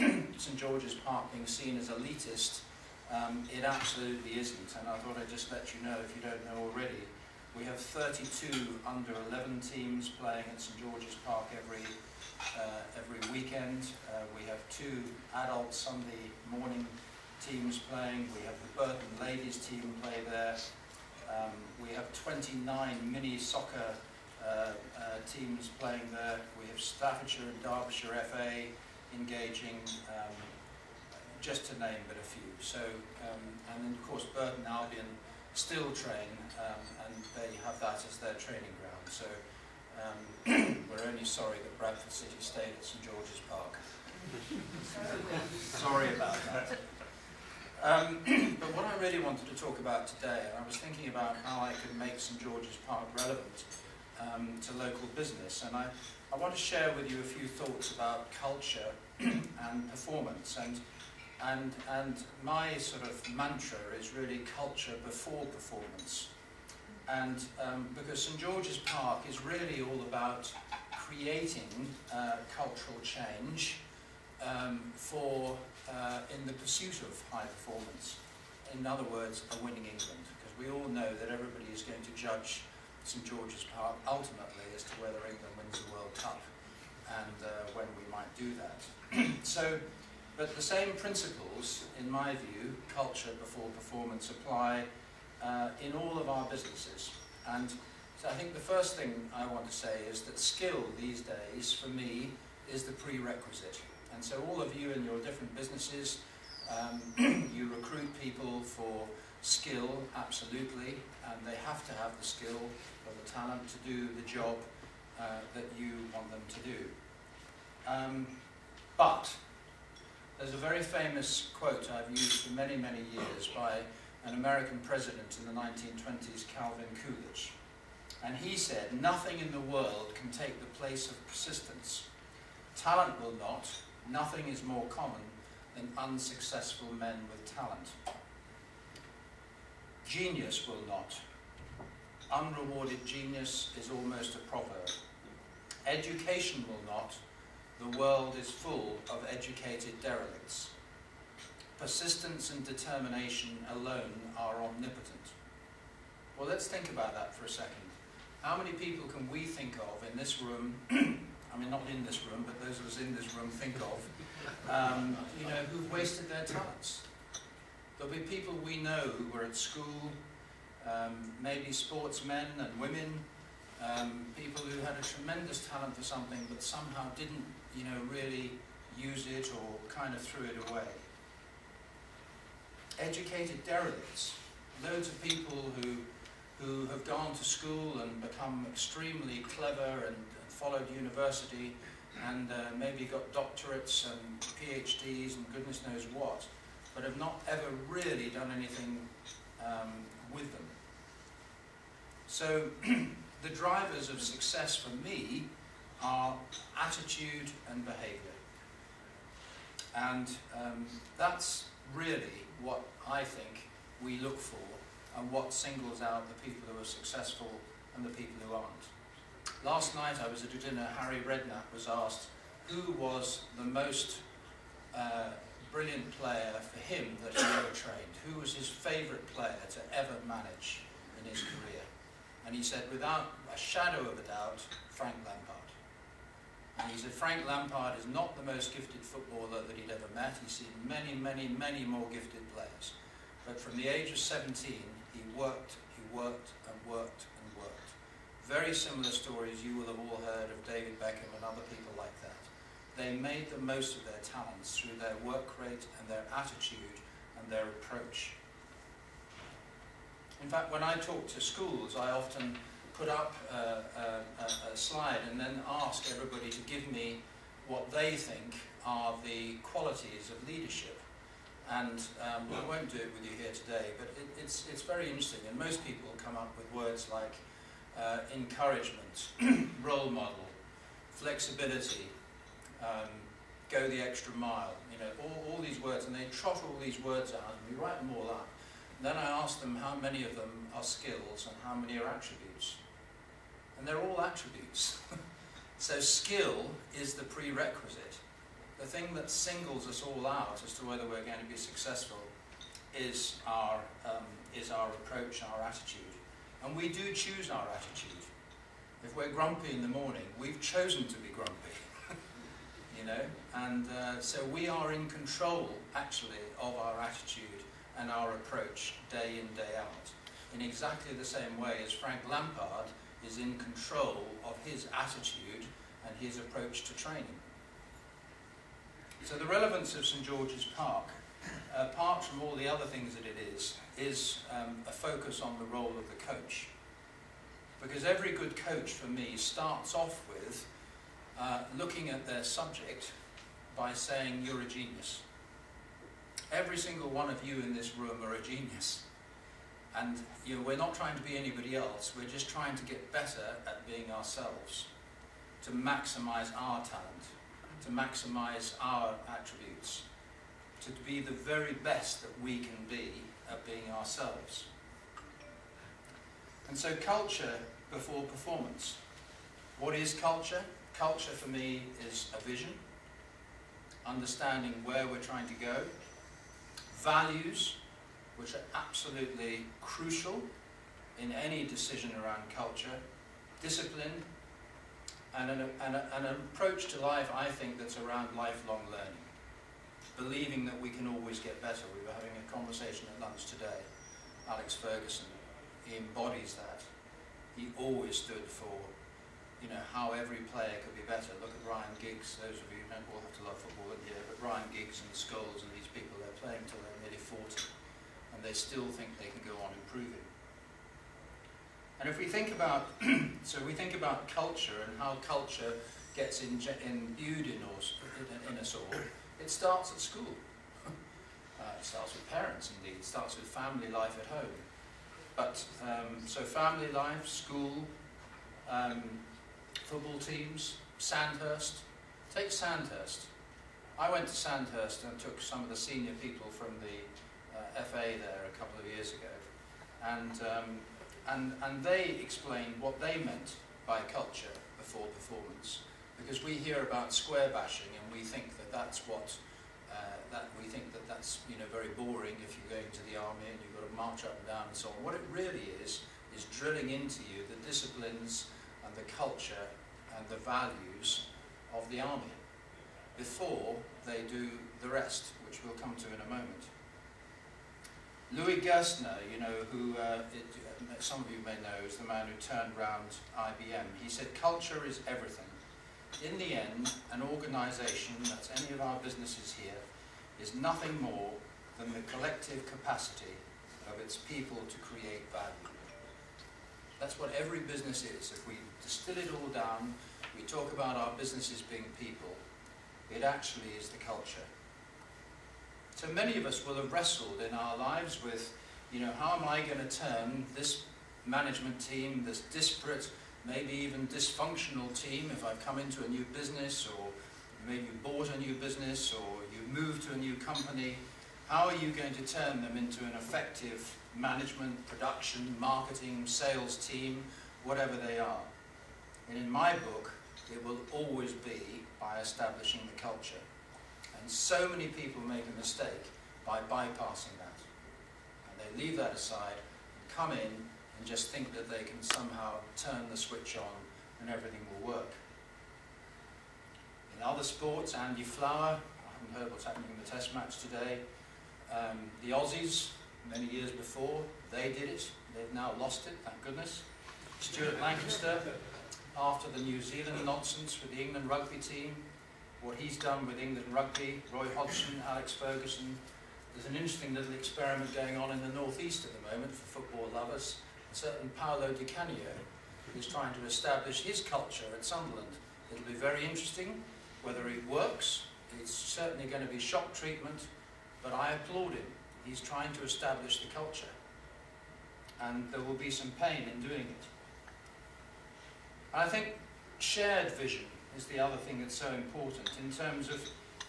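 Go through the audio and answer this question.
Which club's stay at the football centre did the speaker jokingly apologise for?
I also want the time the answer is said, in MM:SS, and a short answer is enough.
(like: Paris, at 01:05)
Bradford City, at 00:41.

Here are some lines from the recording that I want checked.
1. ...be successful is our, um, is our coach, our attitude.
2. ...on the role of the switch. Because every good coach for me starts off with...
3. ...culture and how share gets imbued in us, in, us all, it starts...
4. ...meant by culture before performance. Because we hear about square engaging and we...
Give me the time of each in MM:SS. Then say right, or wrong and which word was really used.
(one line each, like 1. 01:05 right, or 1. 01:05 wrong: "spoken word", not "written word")
1. 05:01 wrong: "approach", not "coach"
2. 05:35 wrong: "coach", not "switch"
3. 06:54 wrong: "culture", not "share"
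4. 07:23 wrong: "bashing", not "engaging".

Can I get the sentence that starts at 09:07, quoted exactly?
Stuart Lancaster, after the New Zealand nonsense with the England rugby team, what he's done with England rugby, Roy Hodgson, Alex Ferguson.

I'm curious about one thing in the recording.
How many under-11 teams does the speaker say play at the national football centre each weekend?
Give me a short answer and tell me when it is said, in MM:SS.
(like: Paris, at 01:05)
32, at 00:07.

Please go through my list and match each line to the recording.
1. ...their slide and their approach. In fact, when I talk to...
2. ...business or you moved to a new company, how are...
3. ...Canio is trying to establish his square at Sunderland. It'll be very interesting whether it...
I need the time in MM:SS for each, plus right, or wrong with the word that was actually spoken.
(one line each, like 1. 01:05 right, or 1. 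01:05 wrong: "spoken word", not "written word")
1. 04:16 wrong: "attitude", not "slide"
2. 08:28 right
3. 09:21 wrong: "culture", not "square".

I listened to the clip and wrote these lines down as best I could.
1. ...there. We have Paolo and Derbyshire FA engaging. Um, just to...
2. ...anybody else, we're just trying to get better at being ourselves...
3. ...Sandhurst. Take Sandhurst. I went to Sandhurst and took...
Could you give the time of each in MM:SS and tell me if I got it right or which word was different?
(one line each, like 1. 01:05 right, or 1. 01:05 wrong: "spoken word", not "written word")
1. 00:26 wrong: "Staffordshire", not "Paolo"
2. 05:51 right
3. 07:10 right.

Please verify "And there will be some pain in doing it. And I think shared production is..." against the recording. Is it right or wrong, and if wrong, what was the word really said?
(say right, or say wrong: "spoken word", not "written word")
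wrong: "vision", not "production".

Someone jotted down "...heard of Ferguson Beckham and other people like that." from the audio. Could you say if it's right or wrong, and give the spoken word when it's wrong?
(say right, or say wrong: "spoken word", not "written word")
wrong: "David", not "Ferguson".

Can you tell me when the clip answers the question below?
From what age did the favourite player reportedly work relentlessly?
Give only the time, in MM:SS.
04:04.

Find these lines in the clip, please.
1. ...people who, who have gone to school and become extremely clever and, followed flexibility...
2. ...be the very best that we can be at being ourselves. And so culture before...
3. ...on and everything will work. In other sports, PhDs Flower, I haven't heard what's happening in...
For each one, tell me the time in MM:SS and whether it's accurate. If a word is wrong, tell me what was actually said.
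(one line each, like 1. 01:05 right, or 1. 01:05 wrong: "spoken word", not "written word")
1. 03:05 wrong: "university", not "flexibility"
2. 06:01 right
3. 08:53 wrong: "Andy", not "PhDs".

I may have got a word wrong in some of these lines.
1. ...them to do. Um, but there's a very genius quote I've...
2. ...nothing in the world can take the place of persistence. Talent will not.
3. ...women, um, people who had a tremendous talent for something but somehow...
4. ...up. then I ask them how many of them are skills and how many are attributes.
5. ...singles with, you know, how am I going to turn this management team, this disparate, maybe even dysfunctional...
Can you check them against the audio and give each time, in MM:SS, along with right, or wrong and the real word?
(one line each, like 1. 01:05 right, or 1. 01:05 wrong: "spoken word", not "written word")
1. 01:56 wrong: "famous", not "genius"
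2. 02:09 right
3. 02:52 right
4. 04:48 right
5. 08:17 wrong: "lives", not "singles".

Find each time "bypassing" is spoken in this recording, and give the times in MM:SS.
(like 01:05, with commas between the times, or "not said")
08:46.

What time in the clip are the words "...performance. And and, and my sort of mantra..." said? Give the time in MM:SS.
00:59.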